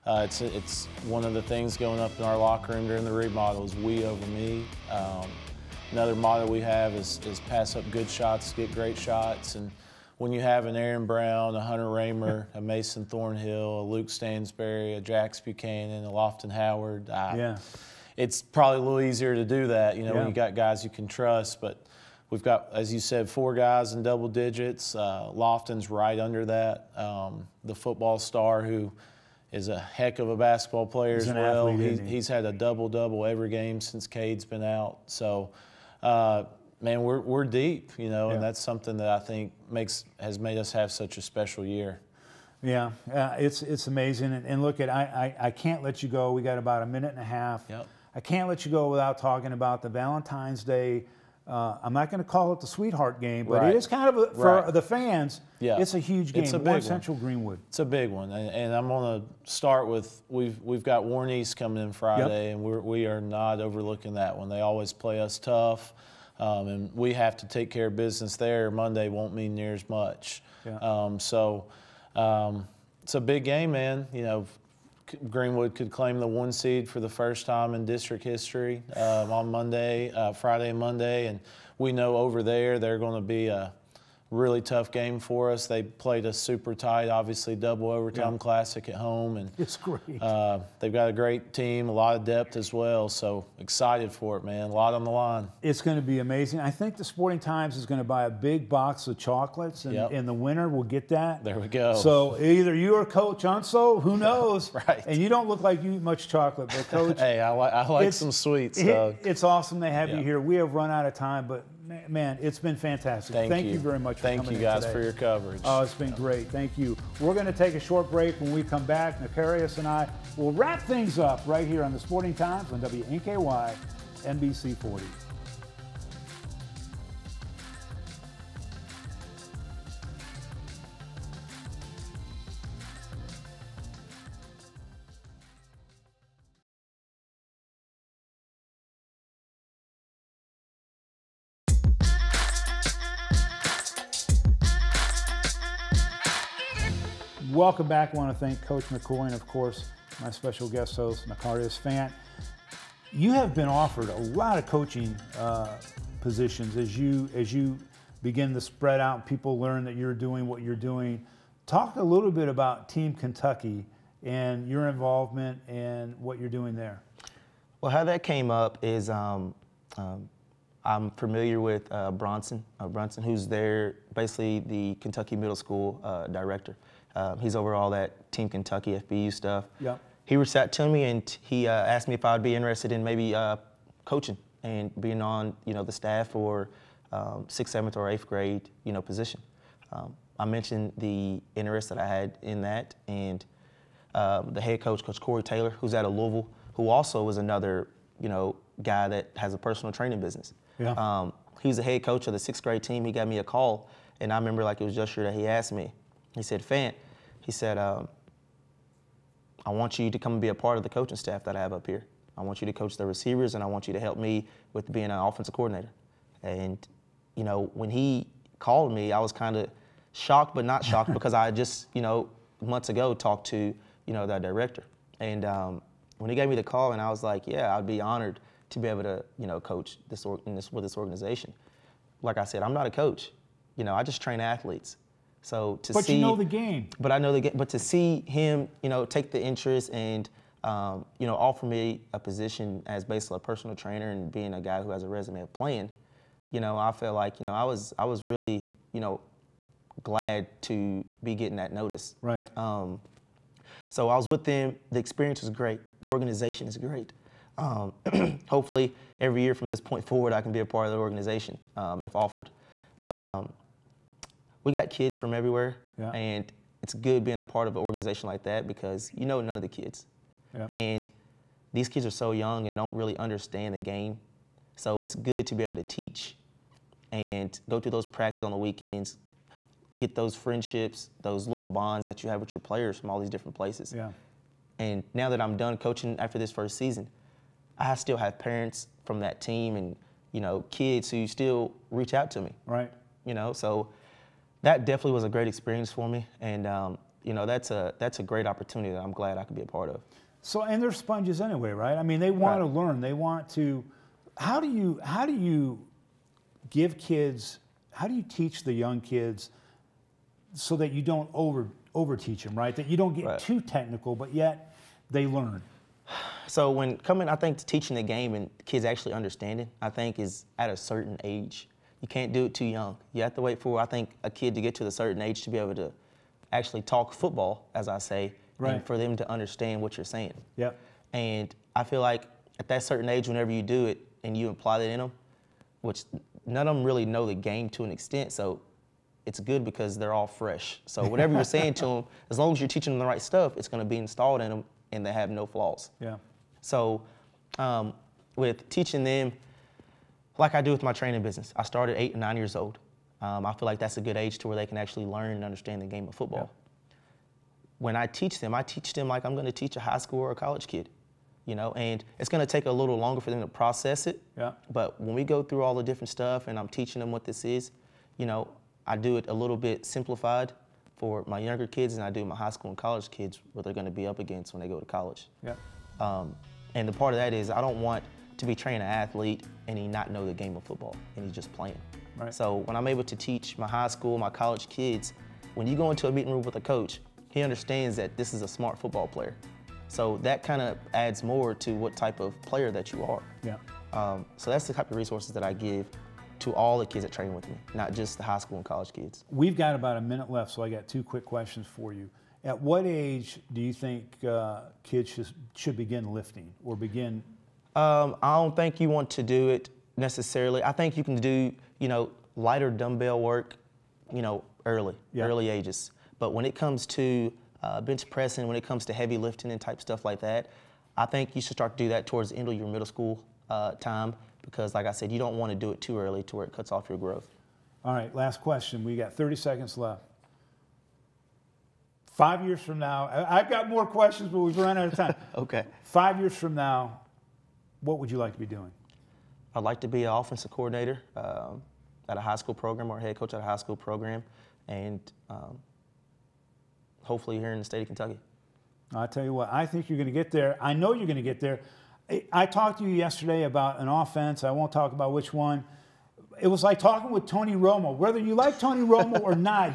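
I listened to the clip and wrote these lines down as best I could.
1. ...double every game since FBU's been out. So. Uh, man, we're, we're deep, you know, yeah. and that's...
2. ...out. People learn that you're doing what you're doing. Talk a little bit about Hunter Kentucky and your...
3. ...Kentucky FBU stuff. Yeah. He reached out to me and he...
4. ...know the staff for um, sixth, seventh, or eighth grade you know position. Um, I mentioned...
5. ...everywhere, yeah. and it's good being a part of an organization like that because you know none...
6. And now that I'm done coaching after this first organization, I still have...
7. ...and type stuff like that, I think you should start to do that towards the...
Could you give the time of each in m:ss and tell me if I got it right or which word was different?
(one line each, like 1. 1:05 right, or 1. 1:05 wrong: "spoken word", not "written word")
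1. 0:32 wrong: "Cade", not "FBU"
2. 2:39 wrong: "Team", not "Hunter"
3. 2:58 right
4. 3:05 right
5. 4:25 right
6. 4:44 wrong: "season", not "organization"
7. 6:59 right.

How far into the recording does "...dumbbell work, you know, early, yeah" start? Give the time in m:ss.
6:52.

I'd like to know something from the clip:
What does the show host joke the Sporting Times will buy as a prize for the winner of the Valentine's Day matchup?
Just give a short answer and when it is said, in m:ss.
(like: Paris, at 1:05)
a big box of chocolates, at 1:38.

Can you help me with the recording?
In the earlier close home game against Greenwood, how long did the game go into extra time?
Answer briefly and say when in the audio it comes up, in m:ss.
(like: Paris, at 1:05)
double overtime, at 1:27.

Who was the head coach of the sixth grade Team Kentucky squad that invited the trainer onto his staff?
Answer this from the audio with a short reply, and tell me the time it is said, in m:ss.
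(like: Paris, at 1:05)
Corey Taylor, at 3:15.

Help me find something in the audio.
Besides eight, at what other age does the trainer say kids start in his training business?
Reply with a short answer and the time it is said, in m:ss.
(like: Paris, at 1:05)
9, at 5:52.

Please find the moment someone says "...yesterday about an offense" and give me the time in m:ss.
7:32.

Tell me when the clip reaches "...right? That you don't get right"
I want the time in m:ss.
5:12.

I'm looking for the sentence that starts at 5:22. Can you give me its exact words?
You can't do it too young.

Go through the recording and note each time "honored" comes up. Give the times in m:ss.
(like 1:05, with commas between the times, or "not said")
3:48.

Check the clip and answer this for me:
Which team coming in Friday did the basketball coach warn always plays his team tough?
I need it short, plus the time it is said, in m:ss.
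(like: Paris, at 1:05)
Warren East, at 1:01.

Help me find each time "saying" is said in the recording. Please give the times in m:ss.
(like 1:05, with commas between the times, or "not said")
5:30, 5:41.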